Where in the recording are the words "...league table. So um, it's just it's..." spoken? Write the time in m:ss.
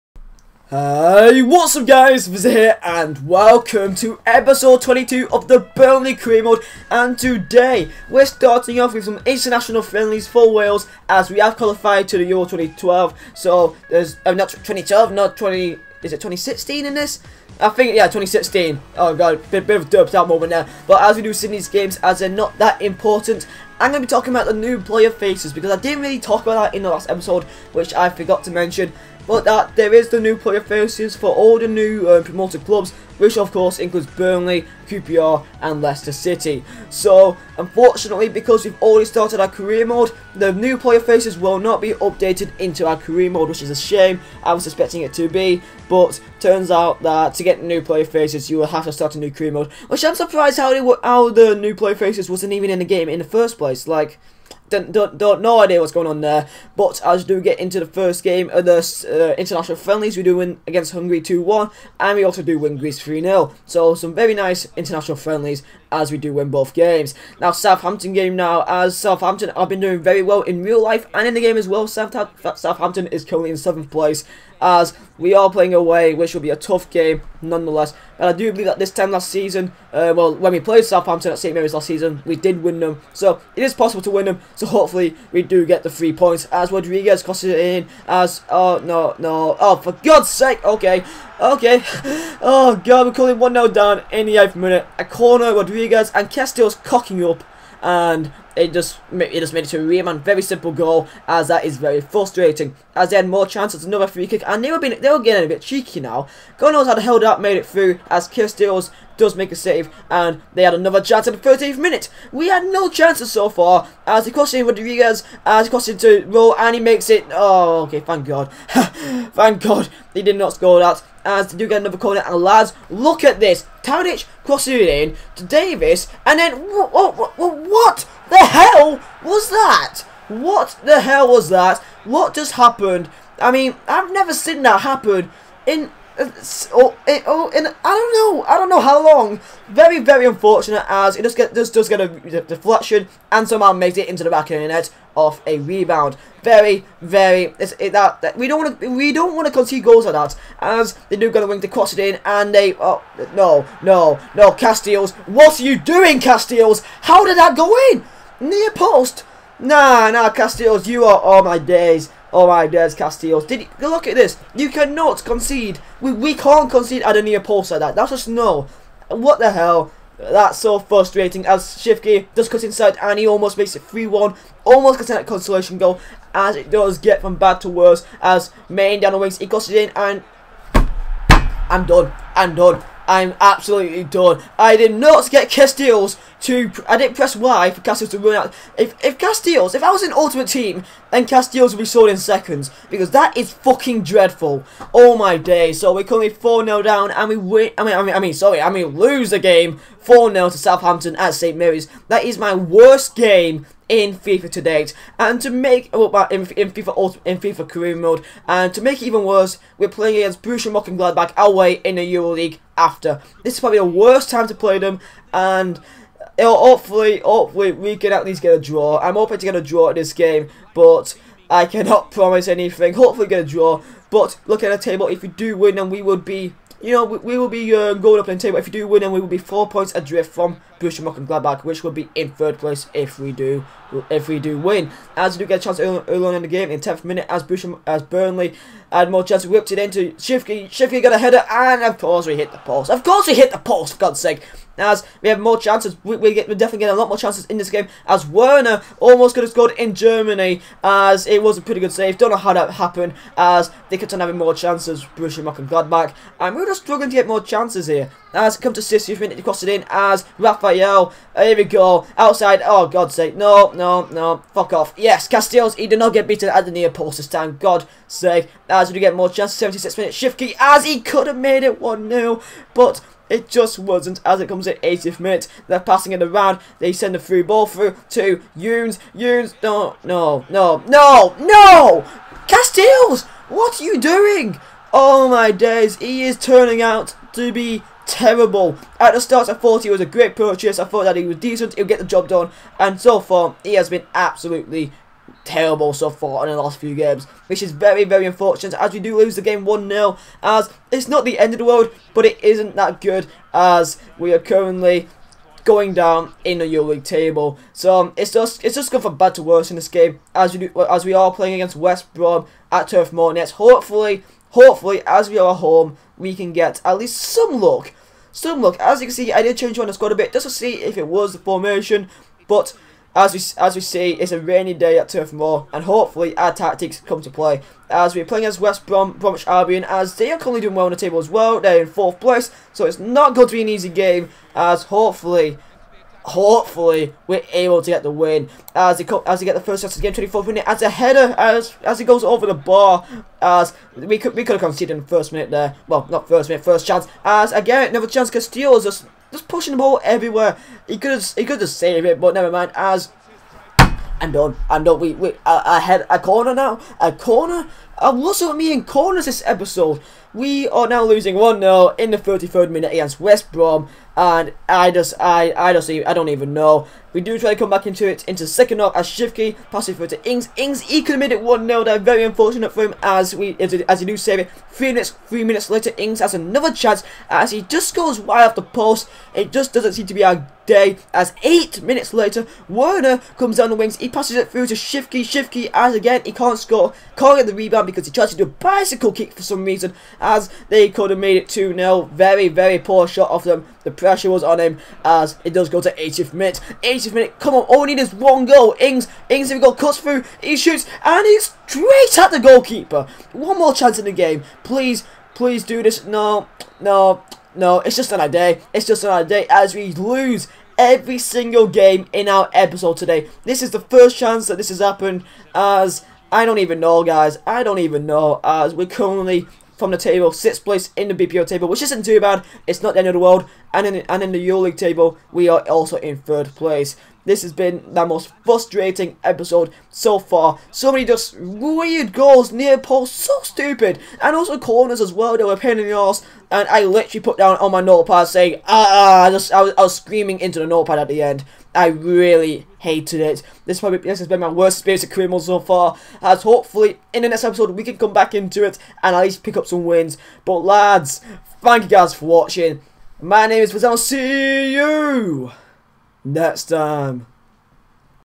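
5:06.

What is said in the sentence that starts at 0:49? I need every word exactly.
Which I'm surprised how, they were, how the new player faces wasn't even in the game in the first place.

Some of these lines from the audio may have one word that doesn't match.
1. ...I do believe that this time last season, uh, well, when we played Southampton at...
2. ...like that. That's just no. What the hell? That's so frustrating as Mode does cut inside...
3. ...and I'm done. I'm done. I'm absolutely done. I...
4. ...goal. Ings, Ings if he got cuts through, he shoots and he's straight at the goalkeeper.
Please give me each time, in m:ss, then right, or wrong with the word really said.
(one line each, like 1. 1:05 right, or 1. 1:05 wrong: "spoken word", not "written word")
1. 1:18 right
2. 2:47 wrong: "Shivke", not "Mode"
3. 2:59 right
4. 6:38 right.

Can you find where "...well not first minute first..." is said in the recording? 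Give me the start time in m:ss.
5:45.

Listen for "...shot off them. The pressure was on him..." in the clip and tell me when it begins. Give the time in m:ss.
6:33.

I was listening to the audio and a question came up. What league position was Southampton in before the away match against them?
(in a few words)
7th.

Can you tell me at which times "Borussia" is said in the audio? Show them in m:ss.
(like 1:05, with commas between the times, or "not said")
3:30, 3:50, 3:57, 4:15.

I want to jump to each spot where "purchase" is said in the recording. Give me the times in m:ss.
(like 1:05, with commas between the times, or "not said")
4:50.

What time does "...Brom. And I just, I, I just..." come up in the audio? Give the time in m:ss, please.
6:03.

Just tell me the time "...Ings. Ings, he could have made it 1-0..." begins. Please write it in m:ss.
6:10.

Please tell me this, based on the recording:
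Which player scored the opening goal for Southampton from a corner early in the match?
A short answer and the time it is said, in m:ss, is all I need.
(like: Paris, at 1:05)
Riemann, at 1:39.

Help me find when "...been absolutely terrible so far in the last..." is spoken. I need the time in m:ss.
4:53.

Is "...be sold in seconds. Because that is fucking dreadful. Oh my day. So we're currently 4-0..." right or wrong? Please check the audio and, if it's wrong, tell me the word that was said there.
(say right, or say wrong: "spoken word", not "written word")
right.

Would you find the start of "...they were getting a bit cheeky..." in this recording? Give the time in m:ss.
1:45.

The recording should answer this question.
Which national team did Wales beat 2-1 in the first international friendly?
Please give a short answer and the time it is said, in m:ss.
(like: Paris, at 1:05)
Hungary, at 1:00.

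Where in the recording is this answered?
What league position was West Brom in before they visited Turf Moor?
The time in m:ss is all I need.
5:31.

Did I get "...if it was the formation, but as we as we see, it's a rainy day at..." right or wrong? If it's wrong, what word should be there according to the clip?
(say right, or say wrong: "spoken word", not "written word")
right.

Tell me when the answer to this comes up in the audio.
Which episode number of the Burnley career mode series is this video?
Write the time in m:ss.
0:04.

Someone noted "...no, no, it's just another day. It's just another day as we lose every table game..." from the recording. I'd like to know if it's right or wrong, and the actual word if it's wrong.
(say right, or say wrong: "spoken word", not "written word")
wrong: "single", not "table".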